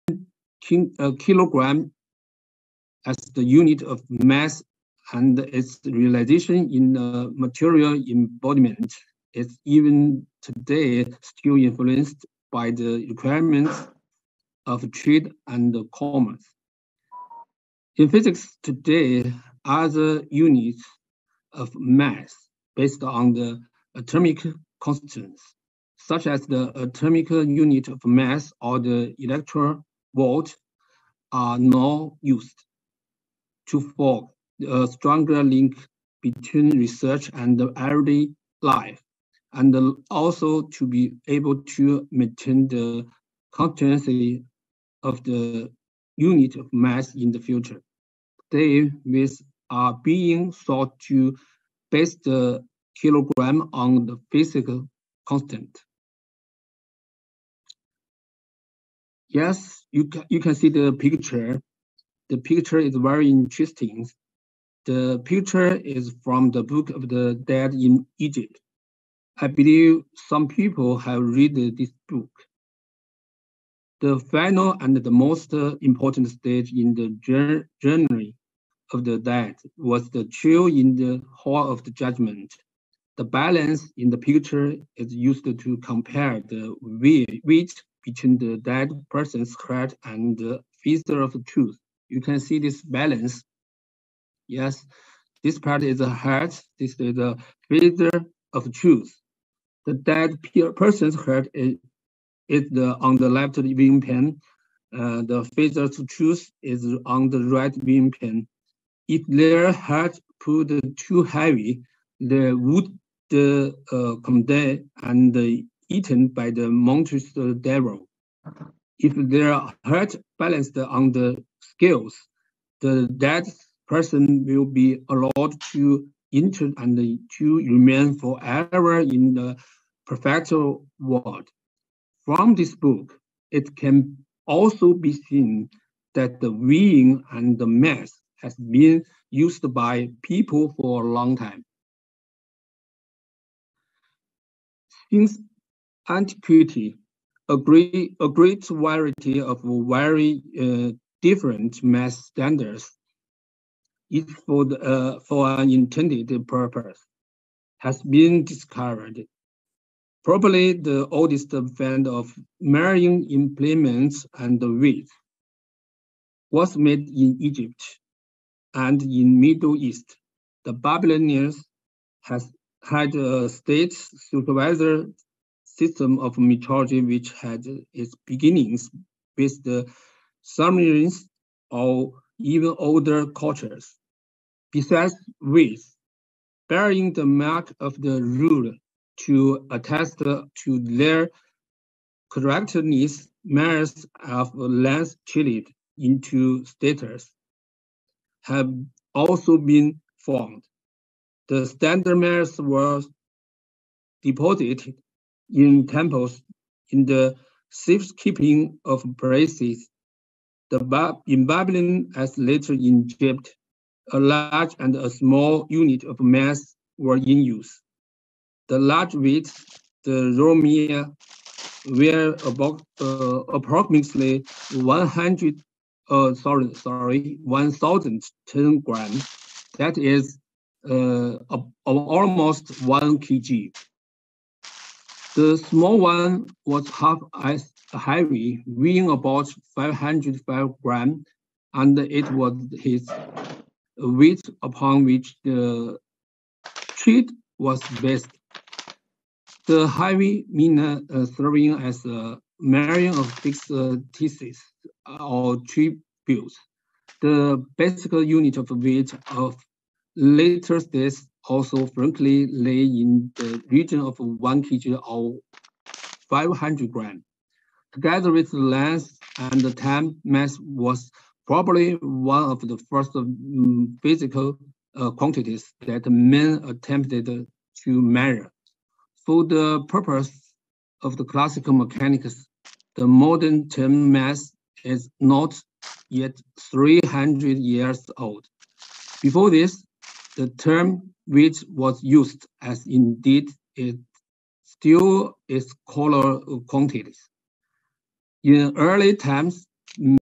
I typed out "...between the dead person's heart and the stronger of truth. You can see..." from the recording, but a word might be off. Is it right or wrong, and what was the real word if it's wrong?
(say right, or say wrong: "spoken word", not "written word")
wrong: "feather", not "stronger".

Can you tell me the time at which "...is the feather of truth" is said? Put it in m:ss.
1:36.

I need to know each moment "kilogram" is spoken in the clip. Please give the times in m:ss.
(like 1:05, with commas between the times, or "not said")
0:01, 0:53.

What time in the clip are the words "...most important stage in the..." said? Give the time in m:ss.
1:15.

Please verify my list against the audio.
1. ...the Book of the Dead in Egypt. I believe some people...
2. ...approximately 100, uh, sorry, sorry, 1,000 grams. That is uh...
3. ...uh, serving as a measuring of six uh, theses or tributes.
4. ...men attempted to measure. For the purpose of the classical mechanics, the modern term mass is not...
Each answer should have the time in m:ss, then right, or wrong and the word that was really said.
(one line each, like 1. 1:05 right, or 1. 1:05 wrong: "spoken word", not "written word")
1. 1:06 right
2. 3:43 right
3. 4:10 right
4. 4:36 right.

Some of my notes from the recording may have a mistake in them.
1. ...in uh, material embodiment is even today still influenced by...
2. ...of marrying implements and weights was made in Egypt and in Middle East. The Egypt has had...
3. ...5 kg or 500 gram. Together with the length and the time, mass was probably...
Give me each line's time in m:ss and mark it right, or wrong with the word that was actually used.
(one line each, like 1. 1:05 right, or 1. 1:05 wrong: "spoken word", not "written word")
1. 0:06 right
2. 2:42 wrong: "Babylonians", not "Egypt"
3. 4:24 wrong: "1", not "5".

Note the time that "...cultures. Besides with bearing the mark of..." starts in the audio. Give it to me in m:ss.
3:03.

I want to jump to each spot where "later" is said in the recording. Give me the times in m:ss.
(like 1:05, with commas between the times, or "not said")
3:32, 4:20.